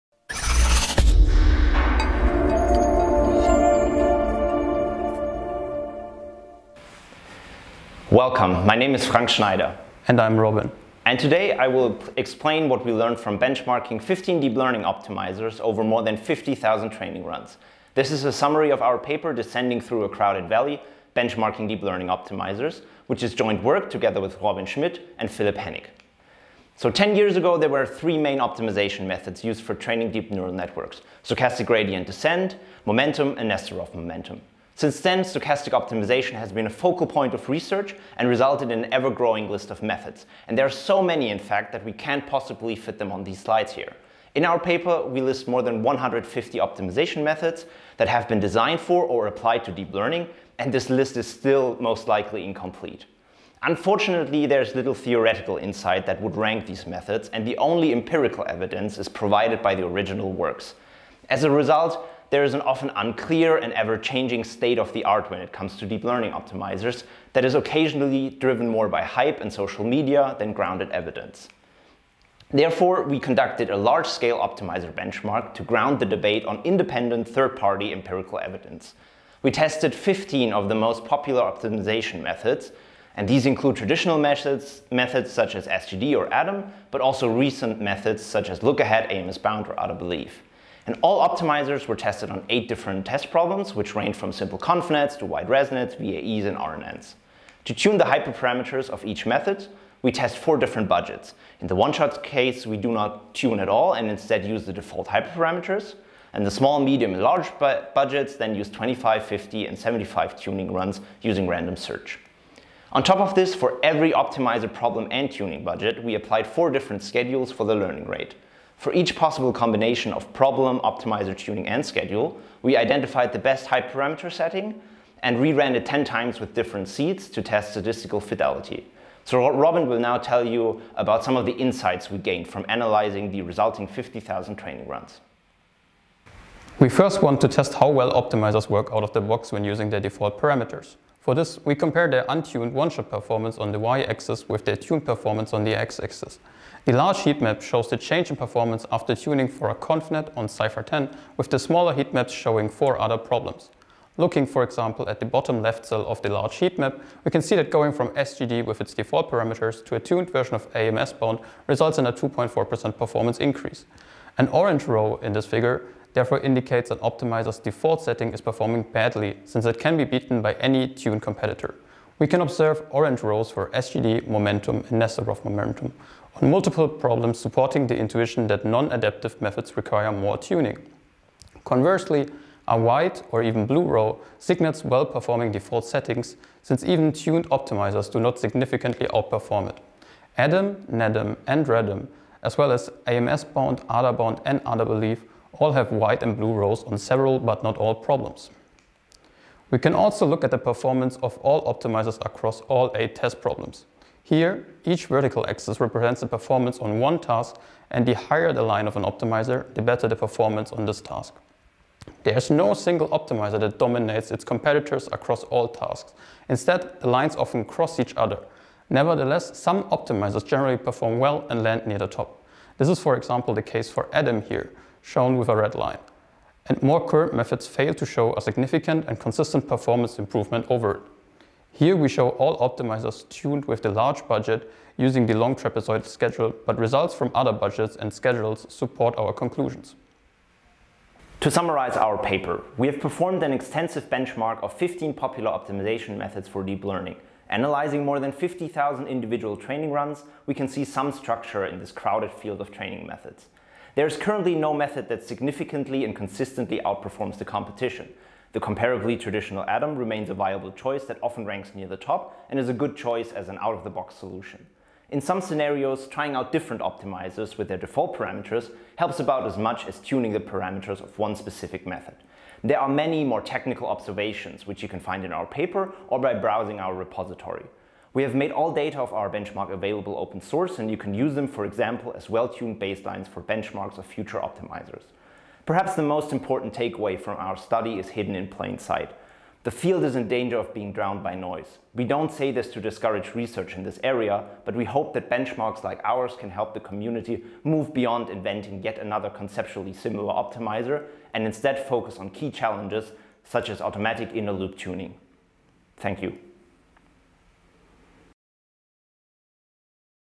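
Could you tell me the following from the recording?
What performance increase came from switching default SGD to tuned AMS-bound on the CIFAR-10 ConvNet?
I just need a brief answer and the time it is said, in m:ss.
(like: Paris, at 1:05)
2.4%, at 2:42.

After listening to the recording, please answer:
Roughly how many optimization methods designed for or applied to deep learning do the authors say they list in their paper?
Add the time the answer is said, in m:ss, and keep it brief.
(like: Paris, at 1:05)
more than 150, at 0:45.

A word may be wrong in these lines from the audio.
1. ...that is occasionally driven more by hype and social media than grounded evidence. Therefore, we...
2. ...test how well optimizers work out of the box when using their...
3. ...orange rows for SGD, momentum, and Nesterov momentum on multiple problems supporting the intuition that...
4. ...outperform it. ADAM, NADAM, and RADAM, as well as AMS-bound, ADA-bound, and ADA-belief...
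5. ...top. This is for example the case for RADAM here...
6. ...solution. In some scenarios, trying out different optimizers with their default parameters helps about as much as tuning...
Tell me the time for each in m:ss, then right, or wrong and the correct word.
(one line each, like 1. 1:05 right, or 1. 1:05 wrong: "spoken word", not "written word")
1. 1:07 right
2. 2:17 right
3. 2:52 right
4. 3:09 right
5. 3:42 wrong: "Adam", not "RADAM"
6. 4:24 right.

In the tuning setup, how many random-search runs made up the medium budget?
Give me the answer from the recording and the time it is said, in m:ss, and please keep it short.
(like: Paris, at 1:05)
50, at 1:49.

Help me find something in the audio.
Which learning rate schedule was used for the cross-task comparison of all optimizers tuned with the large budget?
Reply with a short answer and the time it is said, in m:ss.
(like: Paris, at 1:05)
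long trapezoid schedule, at 3:55.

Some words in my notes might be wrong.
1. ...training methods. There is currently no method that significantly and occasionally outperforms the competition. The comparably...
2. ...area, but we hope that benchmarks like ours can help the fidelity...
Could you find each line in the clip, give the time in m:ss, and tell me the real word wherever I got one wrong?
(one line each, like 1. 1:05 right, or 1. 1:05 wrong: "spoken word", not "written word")
1. 4:12 wrong: "consistently", not "occasionally"
2. 4:54 wrong: "community", not "fidelity".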